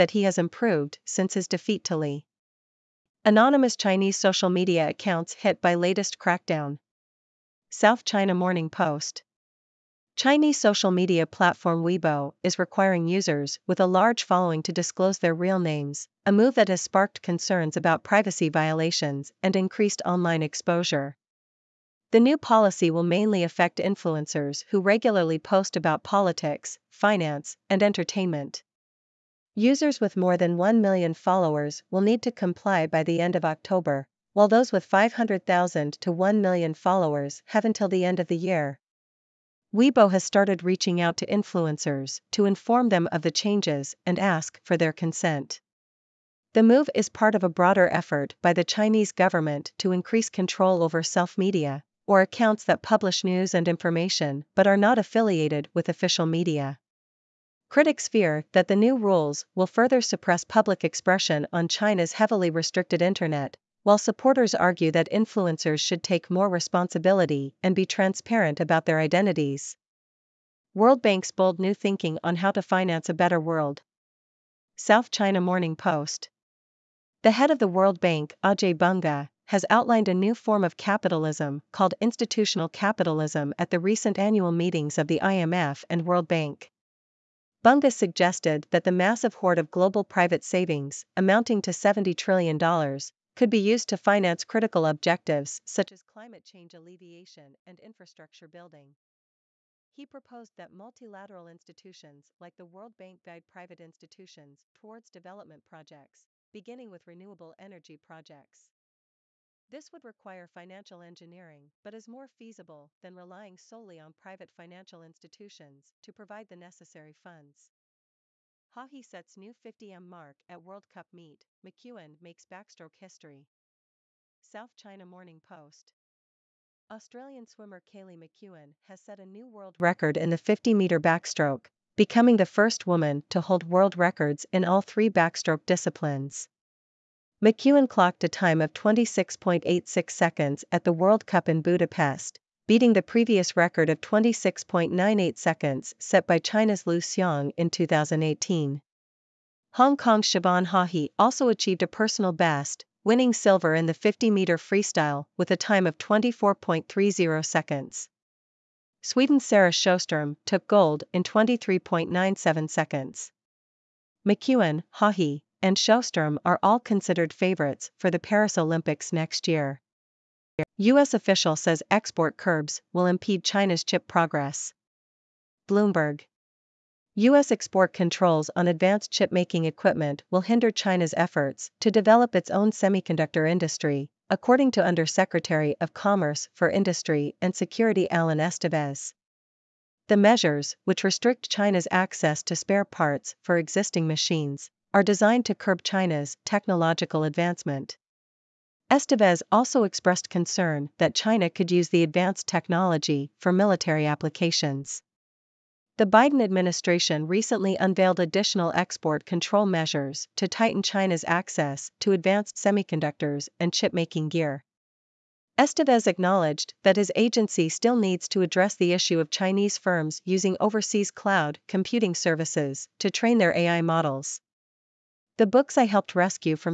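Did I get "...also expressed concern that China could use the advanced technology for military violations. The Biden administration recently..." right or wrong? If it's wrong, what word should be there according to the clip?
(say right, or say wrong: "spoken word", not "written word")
wrong: "applications", not "violations".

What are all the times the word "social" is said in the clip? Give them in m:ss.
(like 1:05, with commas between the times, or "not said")
0:04, 0:10.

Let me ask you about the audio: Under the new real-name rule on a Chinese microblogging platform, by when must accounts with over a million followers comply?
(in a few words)
End of October.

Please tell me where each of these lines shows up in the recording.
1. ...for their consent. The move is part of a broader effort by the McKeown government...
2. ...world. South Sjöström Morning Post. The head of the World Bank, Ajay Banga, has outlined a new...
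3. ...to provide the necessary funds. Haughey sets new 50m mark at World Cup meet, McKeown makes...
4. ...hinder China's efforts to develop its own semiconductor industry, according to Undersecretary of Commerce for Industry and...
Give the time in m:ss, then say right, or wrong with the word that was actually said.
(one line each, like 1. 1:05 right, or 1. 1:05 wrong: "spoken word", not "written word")
1. 0:44 wrong: "Chinese", not "McKeown"
2. 1:13 wrong: "China", not "Sjöström"
3. 1:56 right
4. 3:00 right.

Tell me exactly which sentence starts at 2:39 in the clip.
Sweden's Sarah Sjöström took gold in 23.97 seconds.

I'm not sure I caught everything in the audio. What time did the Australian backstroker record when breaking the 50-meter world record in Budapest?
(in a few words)
26.86 seconds.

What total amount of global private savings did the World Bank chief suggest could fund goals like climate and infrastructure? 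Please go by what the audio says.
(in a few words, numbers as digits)
$70 trillion.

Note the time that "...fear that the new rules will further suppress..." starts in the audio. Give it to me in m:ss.
0:58.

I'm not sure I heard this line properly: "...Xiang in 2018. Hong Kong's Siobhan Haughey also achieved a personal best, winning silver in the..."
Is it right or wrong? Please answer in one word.
right.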